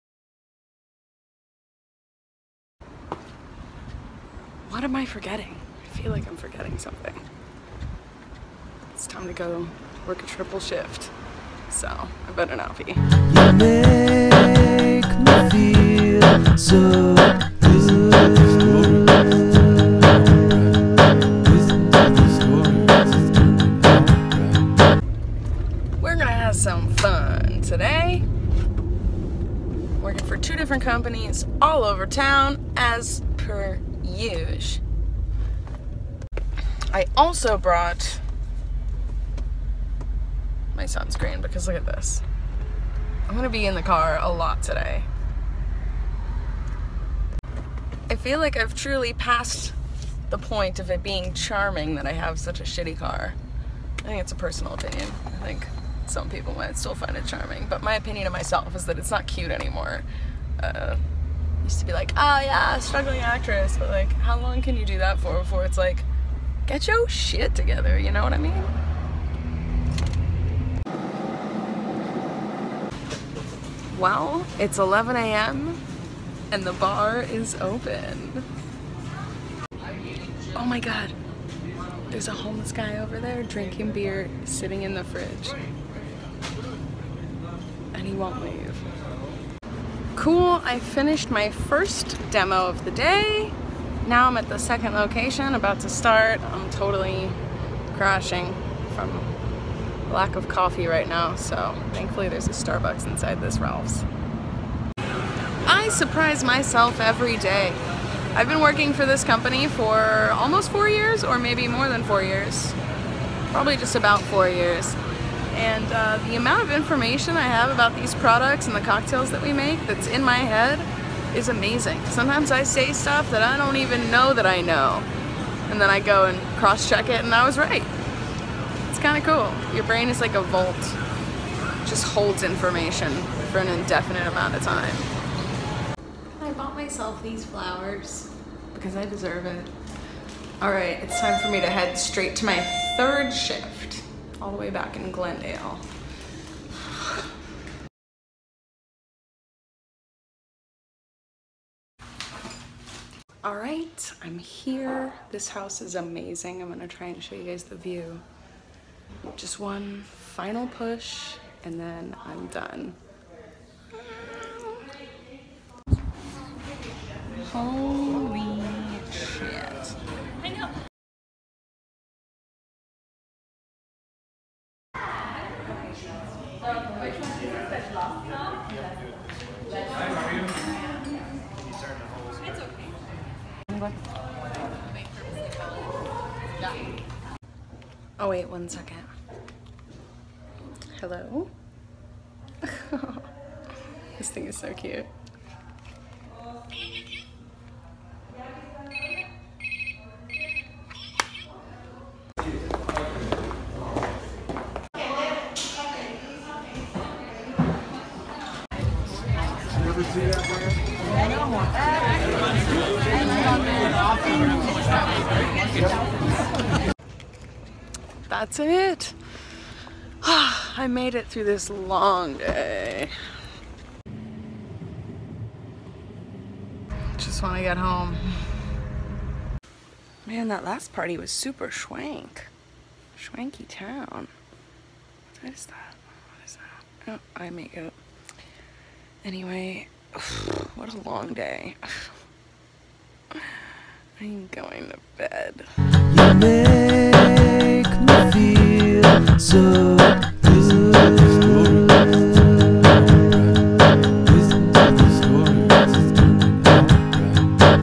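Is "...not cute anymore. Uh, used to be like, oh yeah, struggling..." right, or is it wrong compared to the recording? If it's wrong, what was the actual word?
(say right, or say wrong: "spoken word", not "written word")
right.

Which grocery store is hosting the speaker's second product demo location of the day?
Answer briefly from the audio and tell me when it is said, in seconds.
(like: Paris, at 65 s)
Ralph's, at 103 s.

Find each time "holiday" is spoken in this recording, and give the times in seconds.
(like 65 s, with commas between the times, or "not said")
not said.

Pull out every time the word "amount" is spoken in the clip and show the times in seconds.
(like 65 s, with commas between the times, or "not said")
116 s, 134 s.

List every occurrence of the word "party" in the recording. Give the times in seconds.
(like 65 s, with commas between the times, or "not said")
230 s.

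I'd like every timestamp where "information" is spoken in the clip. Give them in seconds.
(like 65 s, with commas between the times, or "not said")
116 s, 132 s.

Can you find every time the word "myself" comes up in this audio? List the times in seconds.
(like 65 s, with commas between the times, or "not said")
58 s, 106 s, 136 s.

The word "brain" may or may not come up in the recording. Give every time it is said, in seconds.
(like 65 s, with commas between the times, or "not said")
129 s.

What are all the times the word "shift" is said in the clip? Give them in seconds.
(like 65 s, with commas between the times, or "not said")
10 s, 143 s.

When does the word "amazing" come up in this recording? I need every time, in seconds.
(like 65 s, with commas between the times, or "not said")
121 s, 155 s.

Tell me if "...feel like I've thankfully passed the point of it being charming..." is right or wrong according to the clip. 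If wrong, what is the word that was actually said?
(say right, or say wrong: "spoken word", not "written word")
wrong: "truly", not "thankfully".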